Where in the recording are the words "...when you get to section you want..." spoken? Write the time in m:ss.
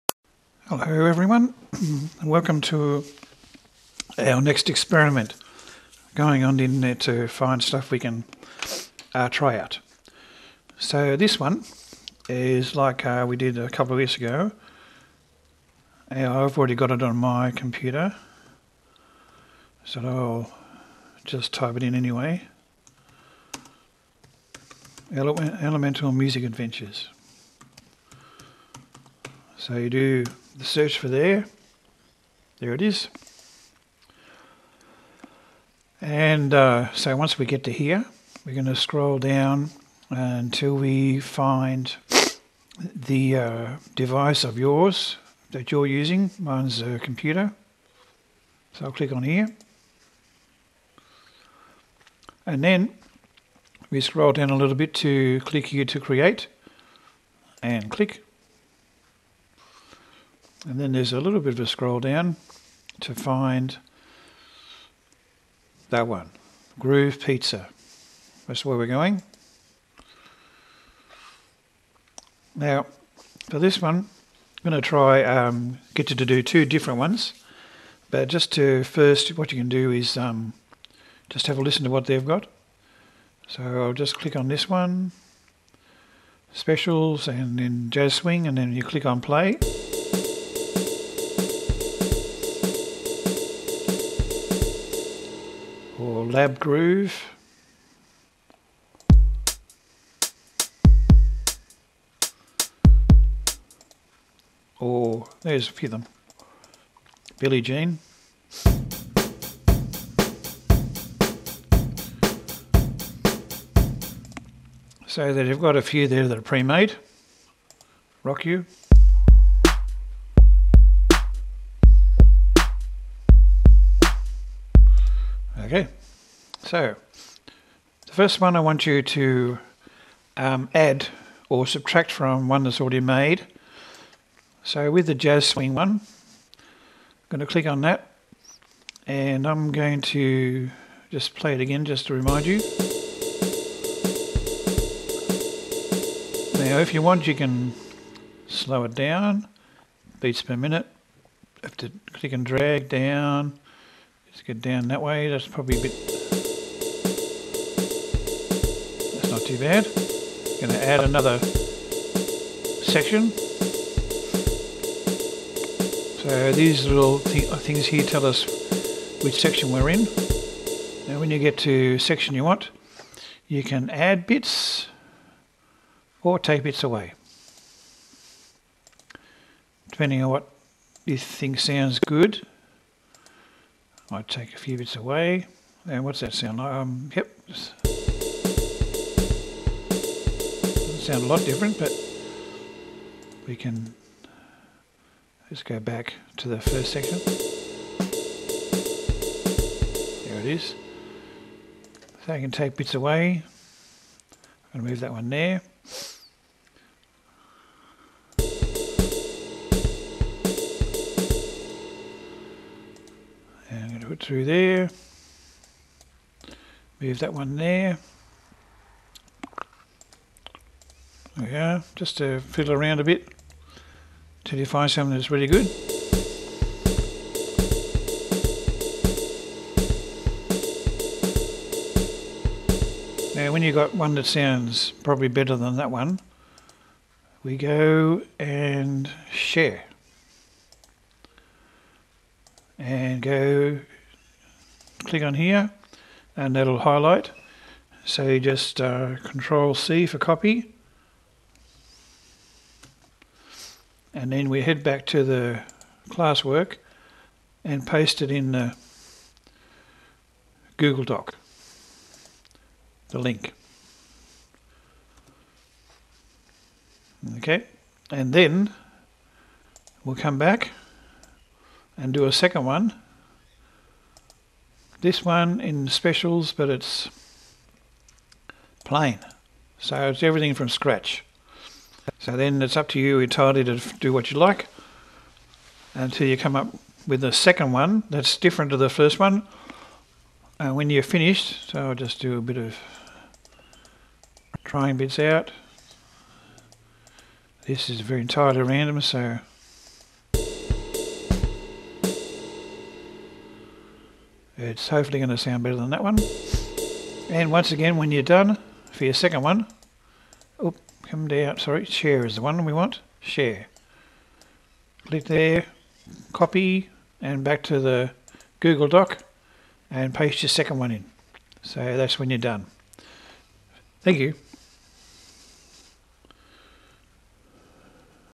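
2:51.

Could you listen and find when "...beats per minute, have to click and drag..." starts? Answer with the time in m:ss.
2:30.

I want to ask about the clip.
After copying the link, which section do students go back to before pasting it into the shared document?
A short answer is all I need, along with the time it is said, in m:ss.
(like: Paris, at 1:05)
classwork, at 4:16.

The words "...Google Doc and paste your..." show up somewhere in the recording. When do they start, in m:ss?
5:18.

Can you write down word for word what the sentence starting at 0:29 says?
So you do the search for there.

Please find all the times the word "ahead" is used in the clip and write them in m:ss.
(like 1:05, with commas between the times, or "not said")
not said.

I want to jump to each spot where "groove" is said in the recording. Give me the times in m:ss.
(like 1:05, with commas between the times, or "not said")
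1:06, 1:36.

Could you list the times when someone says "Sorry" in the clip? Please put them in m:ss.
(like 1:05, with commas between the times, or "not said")
5:11.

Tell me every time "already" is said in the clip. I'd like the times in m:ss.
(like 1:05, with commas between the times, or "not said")
0:16, 2:12.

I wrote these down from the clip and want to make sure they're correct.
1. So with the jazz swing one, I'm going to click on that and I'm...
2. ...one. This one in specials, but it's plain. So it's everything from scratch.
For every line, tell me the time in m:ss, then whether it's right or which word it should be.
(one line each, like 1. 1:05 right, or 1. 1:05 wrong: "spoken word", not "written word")
1. 2:14 right
2. 4:32 right.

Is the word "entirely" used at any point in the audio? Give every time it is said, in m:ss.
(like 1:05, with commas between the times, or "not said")
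4:43, 4:58.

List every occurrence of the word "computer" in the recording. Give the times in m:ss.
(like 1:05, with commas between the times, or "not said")
0:17, 0:46.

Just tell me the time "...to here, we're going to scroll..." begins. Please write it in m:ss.
0:37.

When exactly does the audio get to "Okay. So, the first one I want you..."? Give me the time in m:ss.
2:05.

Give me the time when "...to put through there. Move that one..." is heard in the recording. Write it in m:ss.
3:34.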